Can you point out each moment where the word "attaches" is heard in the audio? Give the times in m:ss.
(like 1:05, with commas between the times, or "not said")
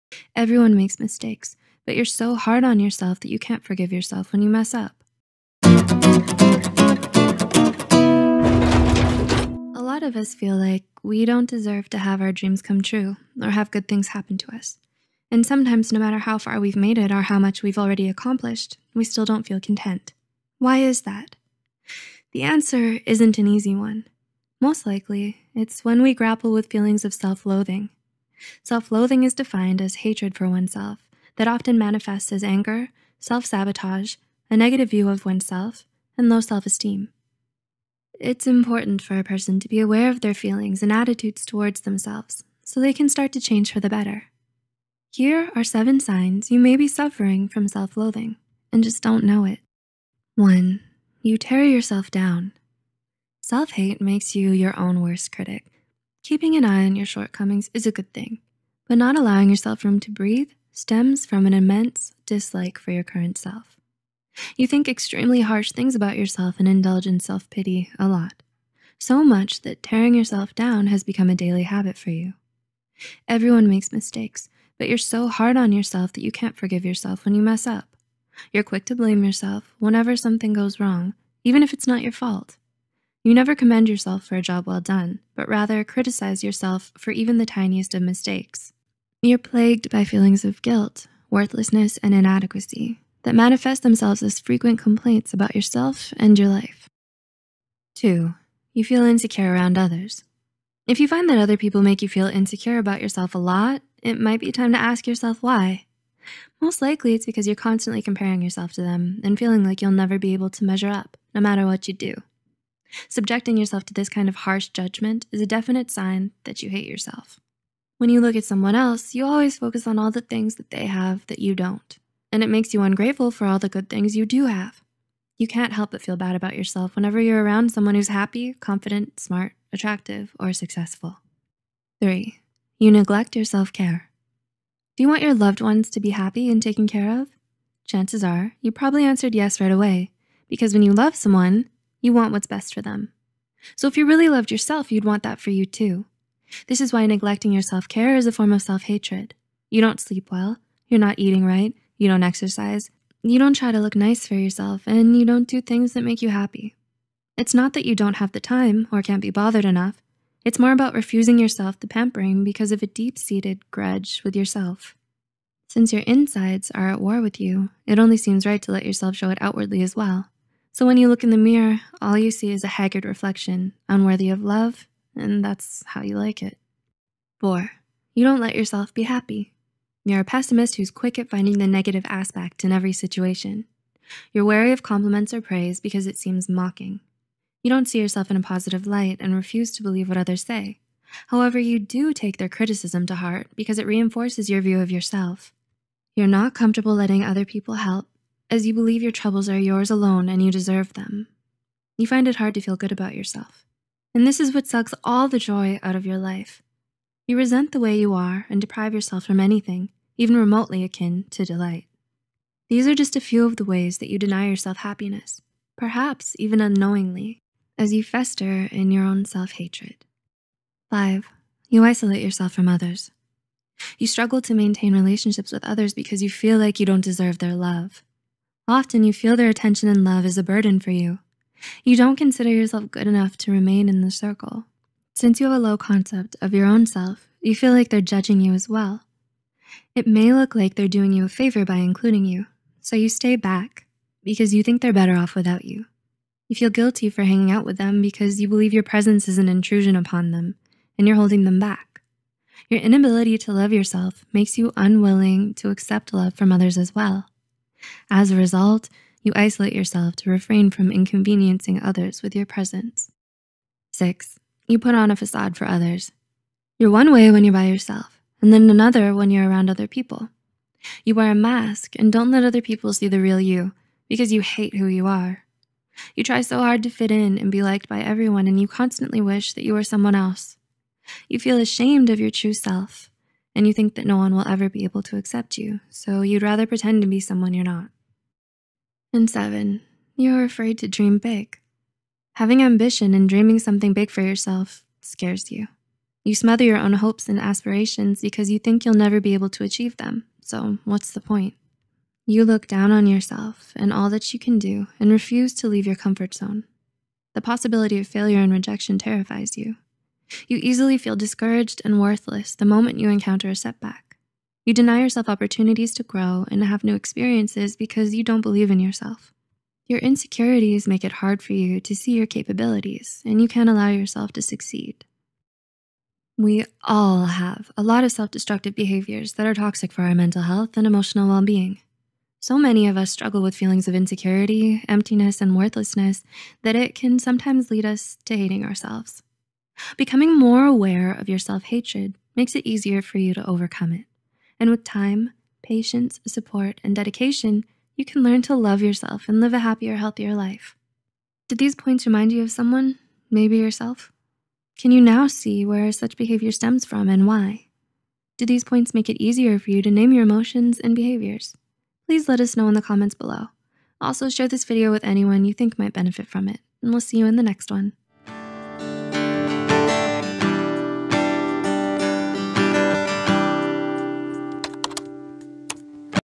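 not said.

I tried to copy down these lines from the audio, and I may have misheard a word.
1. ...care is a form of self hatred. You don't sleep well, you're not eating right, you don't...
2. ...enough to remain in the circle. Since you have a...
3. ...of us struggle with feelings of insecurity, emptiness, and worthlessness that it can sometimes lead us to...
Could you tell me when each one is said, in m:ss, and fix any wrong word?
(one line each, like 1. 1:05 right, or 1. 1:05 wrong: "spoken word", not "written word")
1. 2:27 right
2. 3:53 right
3. 5:32 right.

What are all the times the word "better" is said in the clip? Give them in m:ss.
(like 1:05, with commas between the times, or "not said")
0:43, 4:04.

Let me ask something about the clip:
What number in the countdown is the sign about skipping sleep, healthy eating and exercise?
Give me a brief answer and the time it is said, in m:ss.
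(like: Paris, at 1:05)
3, at 2:12.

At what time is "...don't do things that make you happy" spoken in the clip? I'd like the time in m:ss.
2:35.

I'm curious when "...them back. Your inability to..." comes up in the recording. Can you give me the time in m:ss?
4:11.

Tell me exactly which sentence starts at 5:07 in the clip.
The possibility of failure and rejection terrifies you.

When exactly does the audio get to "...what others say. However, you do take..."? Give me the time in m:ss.
3:10.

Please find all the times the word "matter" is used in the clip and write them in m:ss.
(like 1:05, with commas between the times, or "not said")
0:15, 1:51.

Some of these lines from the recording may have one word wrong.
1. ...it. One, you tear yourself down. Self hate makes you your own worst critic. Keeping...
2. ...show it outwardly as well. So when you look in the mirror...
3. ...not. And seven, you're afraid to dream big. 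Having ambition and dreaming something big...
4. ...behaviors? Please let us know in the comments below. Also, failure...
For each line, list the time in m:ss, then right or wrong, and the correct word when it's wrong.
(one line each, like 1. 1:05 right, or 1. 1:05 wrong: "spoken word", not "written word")
1. 0:49 right
2. 2:49 right
3. 4:47 right
4. 6:00 wrong: "share", not "failure".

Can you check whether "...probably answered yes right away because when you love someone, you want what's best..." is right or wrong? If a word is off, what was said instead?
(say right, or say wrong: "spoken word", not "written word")
right.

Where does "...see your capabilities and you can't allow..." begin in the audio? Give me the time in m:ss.
5:21.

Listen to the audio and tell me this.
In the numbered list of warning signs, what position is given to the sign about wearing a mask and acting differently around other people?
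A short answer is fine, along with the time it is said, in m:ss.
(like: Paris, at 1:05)
6, at 4:23.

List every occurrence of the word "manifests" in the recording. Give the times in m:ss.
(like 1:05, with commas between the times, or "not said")
0:31, 1:33.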